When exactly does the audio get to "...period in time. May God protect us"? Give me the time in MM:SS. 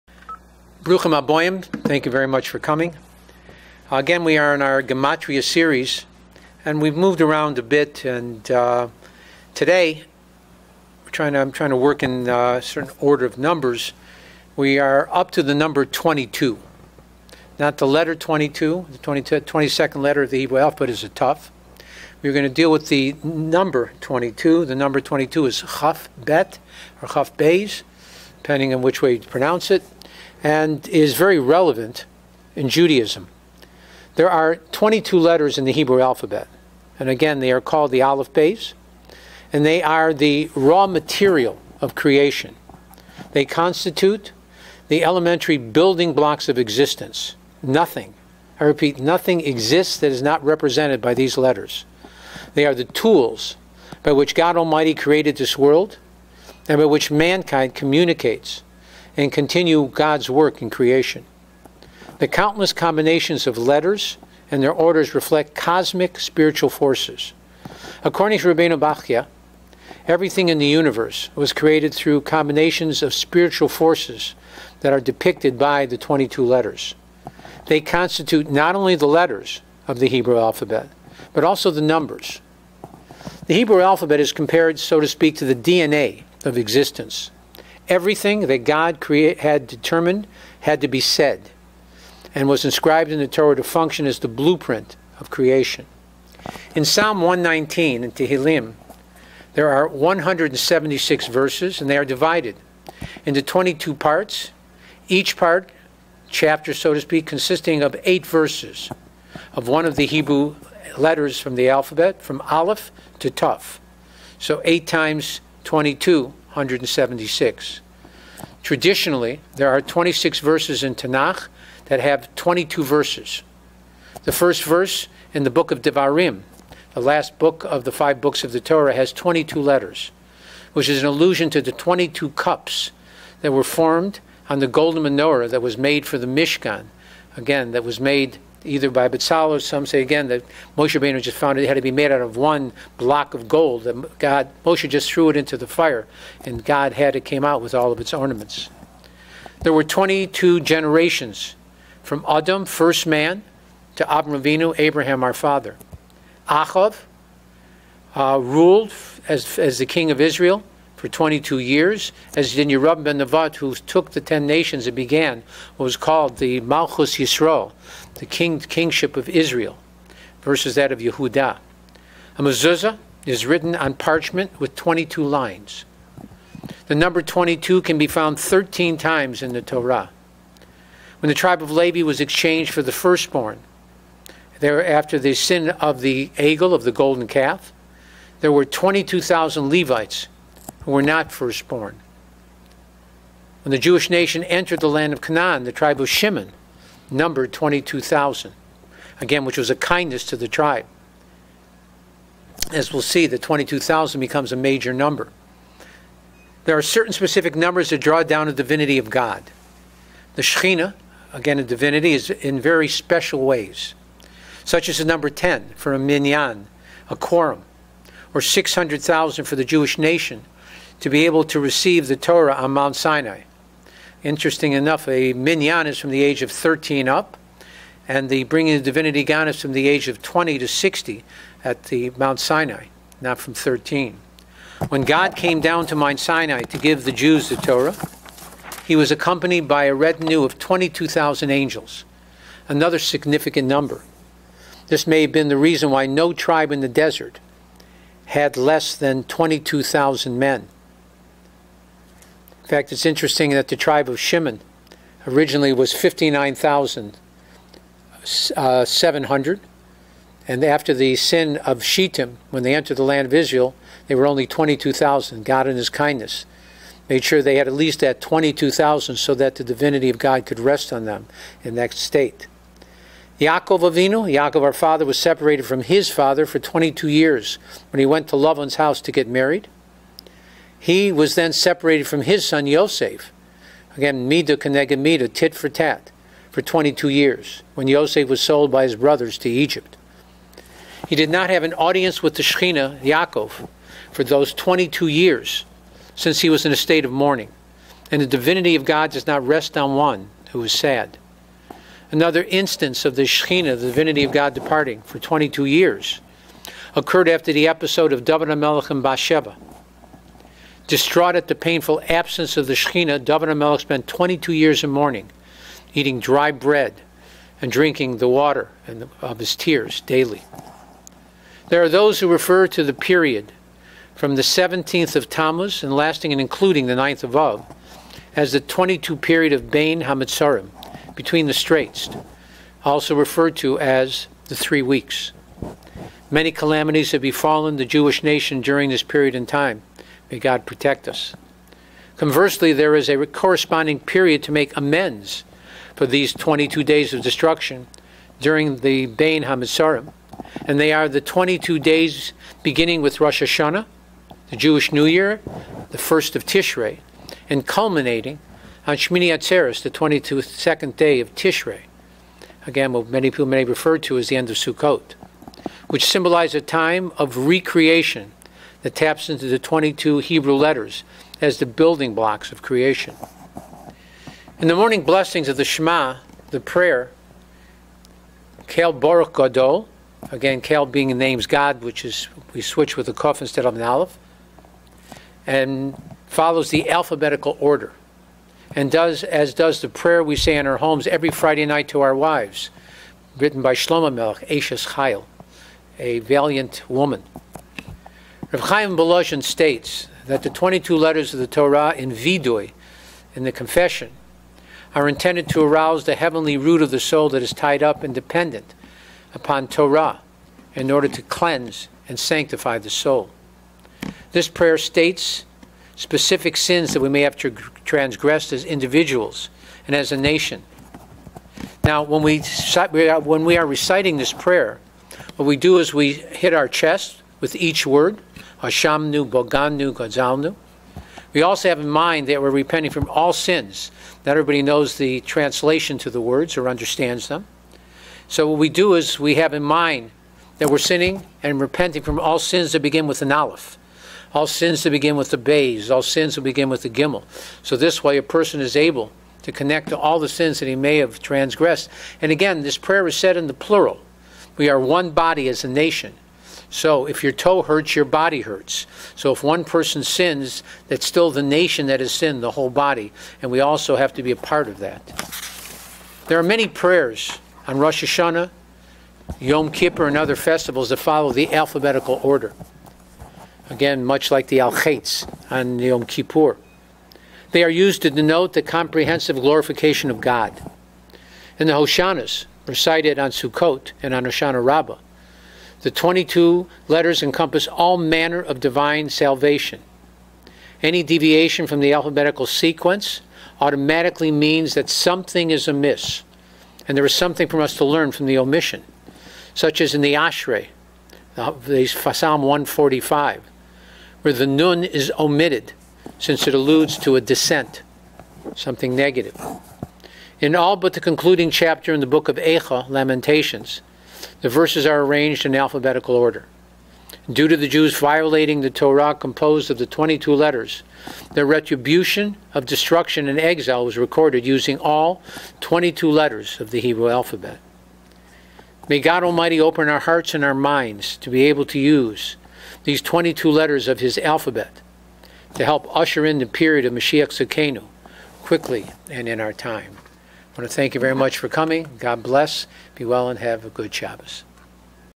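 05:39.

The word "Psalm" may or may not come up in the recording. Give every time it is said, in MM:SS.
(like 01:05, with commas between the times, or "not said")
01:36, 08:22.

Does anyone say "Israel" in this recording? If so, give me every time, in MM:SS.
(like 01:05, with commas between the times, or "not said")
02:40, 02:49, 04:23.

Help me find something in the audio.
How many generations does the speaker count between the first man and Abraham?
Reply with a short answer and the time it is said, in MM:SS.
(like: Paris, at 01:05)
22, at 02:29.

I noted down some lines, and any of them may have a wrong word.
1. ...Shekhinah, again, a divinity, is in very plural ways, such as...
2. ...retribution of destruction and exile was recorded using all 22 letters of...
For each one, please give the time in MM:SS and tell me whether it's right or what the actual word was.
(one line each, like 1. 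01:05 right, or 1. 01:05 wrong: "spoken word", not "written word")
1. 03:30 wrong: "special", not "plural"
2. 08:41 right.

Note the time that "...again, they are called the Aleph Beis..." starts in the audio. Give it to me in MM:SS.
00:37.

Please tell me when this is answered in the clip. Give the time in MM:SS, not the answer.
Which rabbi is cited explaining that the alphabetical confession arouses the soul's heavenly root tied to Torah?
06:38.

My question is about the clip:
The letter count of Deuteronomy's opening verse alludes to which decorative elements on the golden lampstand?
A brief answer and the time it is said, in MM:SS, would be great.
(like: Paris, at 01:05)
22 cups, at 02:11.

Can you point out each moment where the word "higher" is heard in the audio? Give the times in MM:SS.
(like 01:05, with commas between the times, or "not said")
not said.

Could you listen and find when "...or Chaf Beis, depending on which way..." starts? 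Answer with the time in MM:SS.
00:27.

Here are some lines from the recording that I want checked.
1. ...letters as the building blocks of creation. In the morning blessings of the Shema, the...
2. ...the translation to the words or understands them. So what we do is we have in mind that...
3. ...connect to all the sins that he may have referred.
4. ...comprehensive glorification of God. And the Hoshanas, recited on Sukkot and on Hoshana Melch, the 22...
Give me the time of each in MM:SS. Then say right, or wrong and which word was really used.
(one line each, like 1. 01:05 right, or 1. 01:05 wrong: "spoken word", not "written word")
1. 06:10 right
2. 07:14 right
3. 07:29 wrong: "transgressed", not "referred"
4. 07:58 wrong: "Rabbah", not "Melch".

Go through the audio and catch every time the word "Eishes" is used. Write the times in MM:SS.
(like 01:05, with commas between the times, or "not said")
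06:34.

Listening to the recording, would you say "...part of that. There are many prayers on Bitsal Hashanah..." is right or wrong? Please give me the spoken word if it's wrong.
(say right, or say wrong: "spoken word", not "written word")
wrong: "Rosh", not "Bitsal".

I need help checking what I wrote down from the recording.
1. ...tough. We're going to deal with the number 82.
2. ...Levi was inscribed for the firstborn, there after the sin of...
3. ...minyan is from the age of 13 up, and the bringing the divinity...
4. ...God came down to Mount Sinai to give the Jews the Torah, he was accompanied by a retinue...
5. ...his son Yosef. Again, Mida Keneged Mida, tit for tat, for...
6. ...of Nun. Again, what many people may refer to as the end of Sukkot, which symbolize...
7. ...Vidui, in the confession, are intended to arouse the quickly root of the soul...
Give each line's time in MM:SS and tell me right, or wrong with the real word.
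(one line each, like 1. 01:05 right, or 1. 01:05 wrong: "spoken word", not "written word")
1. 00:21 wrong: "22", not "82"
2. 03:01 wrong: "exchanged", not "inscribed"
3. 03:45 right
4. 03:55 right
5. 04:42 right
6. 06:01 wrong: "Tishrei", not "Nun"
7. 06:42 wrong: "heavenly", not "quickly".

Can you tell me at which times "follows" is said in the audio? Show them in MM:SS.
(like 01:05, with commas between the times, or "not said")
06:26, 07:50.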